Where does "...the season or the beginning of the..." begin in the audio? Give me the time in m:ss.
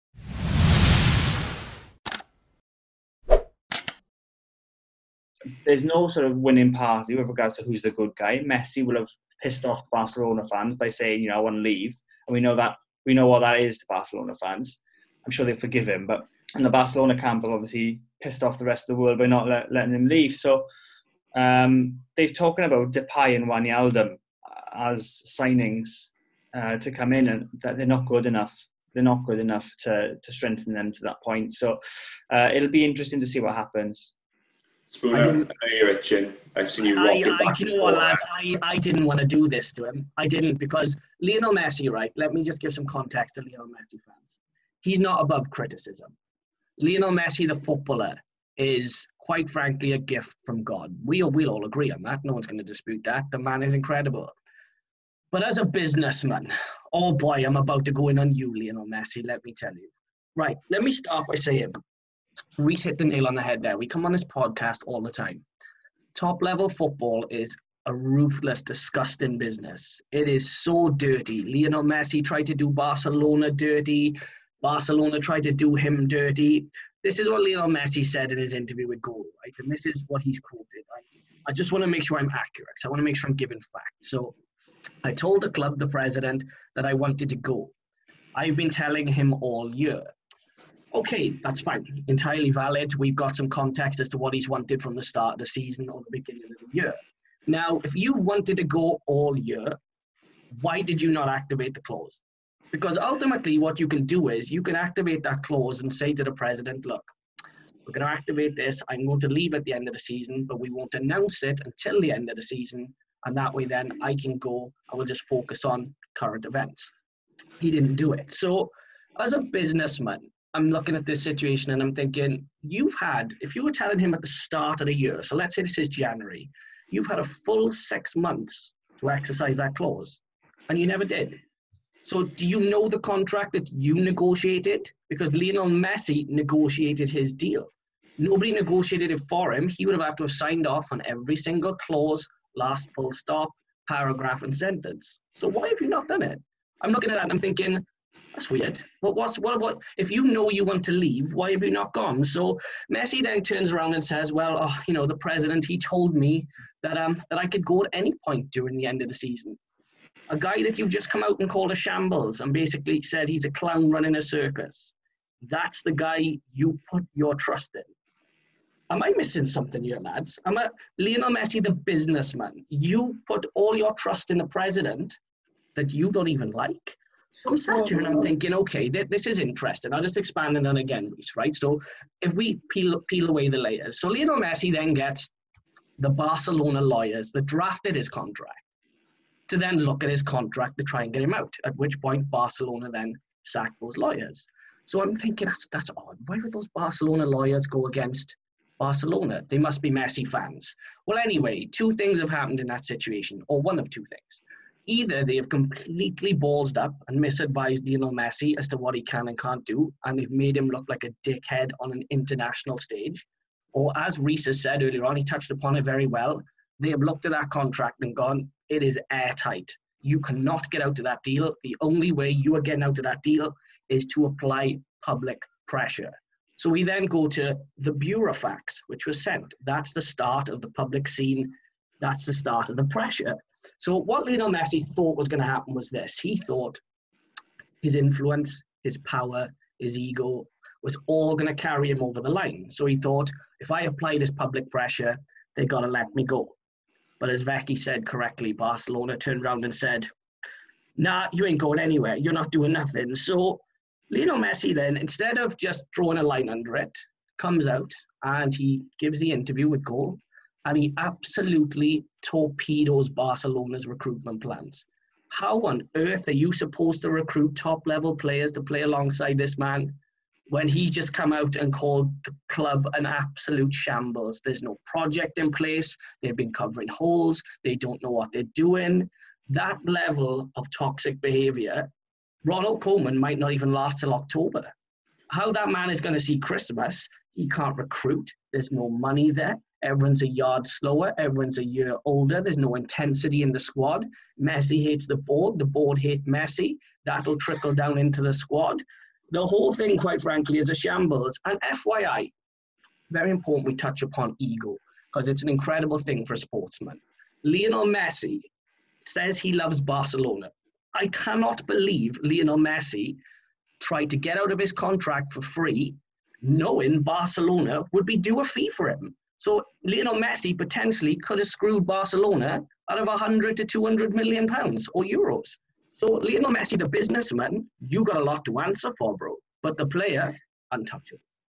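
1:35.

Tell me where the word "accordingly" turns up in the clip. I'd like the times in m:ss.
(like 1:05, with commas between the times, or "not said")
not said.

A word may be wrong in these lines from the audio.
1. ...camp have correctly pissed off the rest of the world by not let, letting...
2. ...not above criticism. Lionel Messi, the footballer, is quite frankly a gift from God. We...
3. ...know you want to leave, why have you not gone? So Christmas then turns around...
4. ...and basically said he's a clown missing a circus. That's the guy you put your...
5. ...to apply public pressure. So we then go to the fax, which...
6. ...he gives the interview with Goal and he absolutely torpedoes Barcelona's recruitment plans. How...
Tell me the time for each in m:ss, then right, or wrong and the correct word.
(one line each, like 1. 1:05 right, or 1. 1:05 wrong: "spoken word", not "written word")
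1. 0:17 wrong: "obviously", not "correctly"
2. 0:44 right
3. 2:30 wrong: "Messi", not "Christmas"
4. 2:42 wrong: "running", not "missing"
5. 3:44 right
6. 4:18 right.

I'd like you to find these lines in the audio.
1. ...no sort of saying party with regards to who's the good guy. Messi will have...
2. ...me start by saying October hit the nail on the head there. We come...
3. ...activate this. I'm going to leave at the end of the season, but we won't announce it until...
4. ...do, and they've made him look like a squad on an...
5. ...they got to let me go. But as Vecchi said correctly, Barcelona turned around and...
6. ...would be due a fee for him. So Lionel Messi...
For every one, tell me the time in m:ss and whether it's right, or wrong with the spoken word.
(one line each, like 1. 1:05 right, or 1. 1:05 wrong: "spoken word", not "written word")
1. 0:05 wrong: "winning", not "saying"
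2. 1:00 wrong: "Reese", not "October"
3. 1:48 right
4. 3:29 wrong: "dickhead", not "squad"
5. 4:05 right
6. 5:17 right.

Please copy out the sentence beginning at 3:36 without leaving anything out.
They have looked at that contract and gone, it is airtight.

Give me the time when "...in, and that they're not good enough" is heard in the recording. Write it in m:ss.
0:27.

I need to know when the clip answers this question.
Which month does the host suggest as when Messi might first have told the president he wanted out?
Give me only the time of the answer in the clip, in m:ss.
2:05.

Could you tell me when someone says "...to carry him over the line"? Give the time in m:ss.
4:01.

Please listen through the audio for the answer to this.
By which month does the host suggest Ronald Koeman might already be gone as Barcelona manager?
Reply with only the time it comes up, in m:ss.
4:44.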